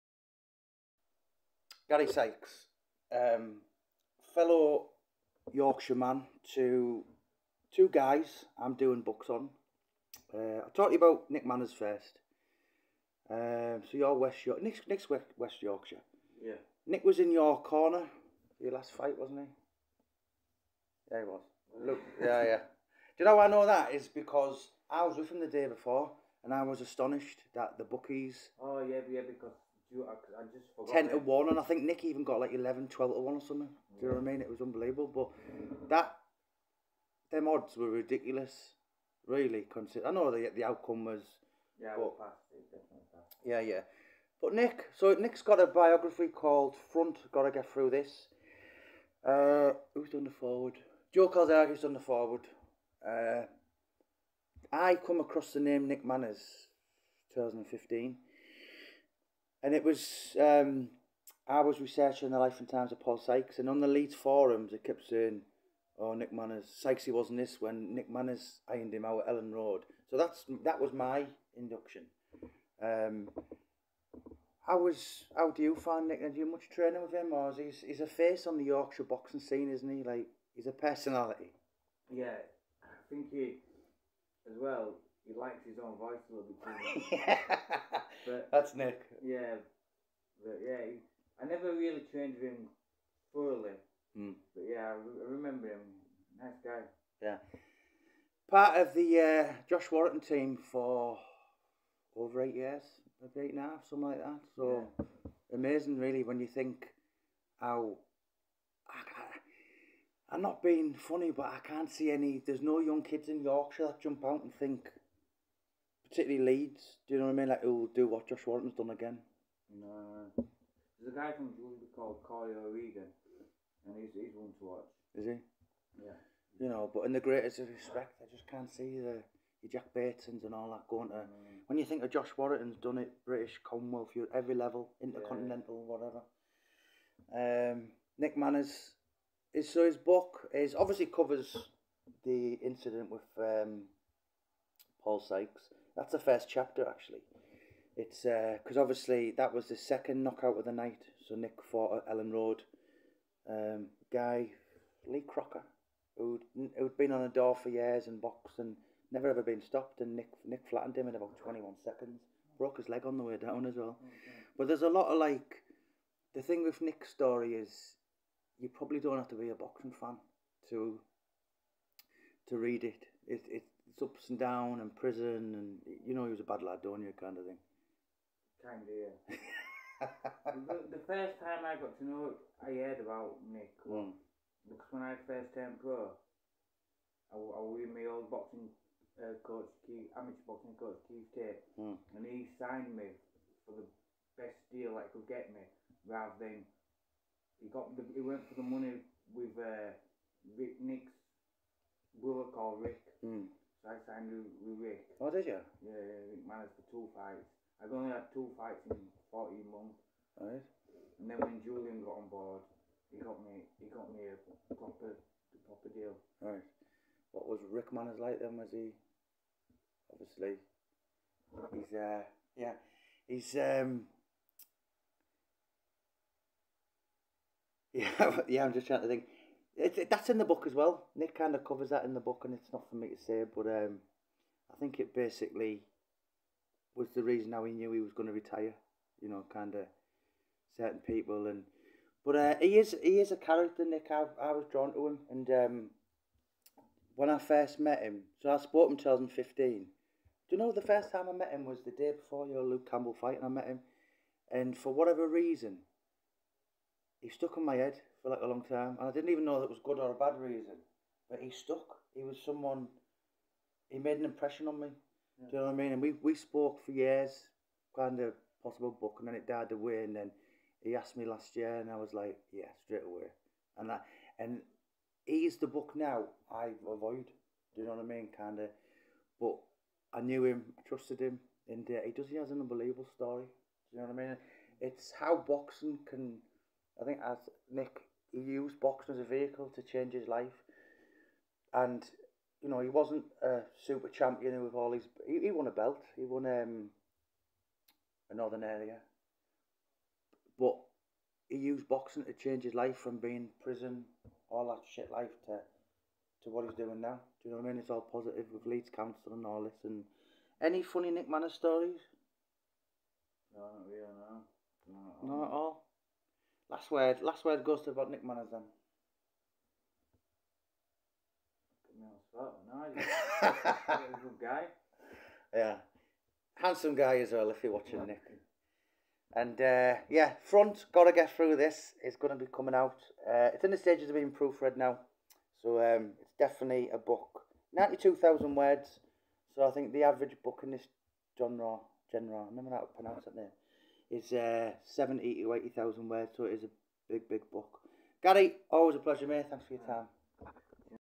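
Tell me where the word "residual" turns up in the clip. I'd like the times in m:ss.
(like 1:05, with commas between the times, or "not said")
not said.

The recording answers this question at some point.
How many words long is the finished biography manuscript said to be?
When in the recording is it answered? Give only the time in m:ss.
5:37.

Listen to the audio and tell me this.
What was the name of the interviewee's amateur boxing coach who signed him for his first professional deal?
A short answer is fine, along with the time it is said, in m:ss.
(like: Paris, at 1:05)
Keith Tate, at 3:11.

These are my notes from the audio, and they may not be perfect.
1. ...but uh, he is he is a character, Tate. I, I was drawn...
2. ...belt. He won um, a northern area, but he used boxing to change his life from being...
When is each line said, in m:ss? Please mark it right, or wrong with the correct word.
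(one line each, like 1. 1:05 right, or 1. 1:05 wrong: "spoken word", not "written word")
1. 4:02 wrong: "Nick", not "Tate"
2. 4:55 right.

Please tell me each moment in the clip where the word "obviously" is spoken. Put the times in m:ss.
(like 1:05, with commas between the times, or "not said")
2:20, 2:28, 3:40.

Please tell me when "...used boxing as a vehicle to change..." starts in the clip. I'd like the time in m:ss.
4:48.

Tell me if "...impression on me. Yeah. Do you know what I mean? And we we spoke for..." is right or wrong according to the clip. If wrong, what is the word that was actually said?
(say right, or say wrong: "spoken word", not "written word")
right.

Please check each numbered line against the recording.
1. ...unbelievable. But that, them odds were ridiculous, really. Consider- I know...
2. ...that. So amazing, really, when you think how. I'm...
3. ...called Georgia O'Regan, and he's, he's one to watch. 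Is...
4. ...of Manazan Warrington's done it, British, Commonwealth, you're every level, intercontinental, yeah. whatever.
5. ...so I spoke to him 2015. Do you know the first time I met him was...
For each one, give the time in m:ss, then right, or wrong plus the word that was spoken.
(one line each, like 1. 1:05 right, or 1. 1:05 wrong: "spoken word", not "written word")
1. 0:34 right
2. 1:44 right
3. 2:01 wrong: "Collier", not "Georgia"
4. 2:12 wrong: "Josh", not "Manazan"
5. 4:08 right.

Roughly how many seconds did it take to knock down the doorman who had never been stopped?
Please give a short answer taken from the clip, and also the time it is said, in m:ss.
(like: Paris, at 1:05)
21, at 2:41.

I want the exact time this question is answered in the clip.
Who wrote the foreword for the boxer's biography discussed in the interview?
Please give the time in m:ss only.
0:51.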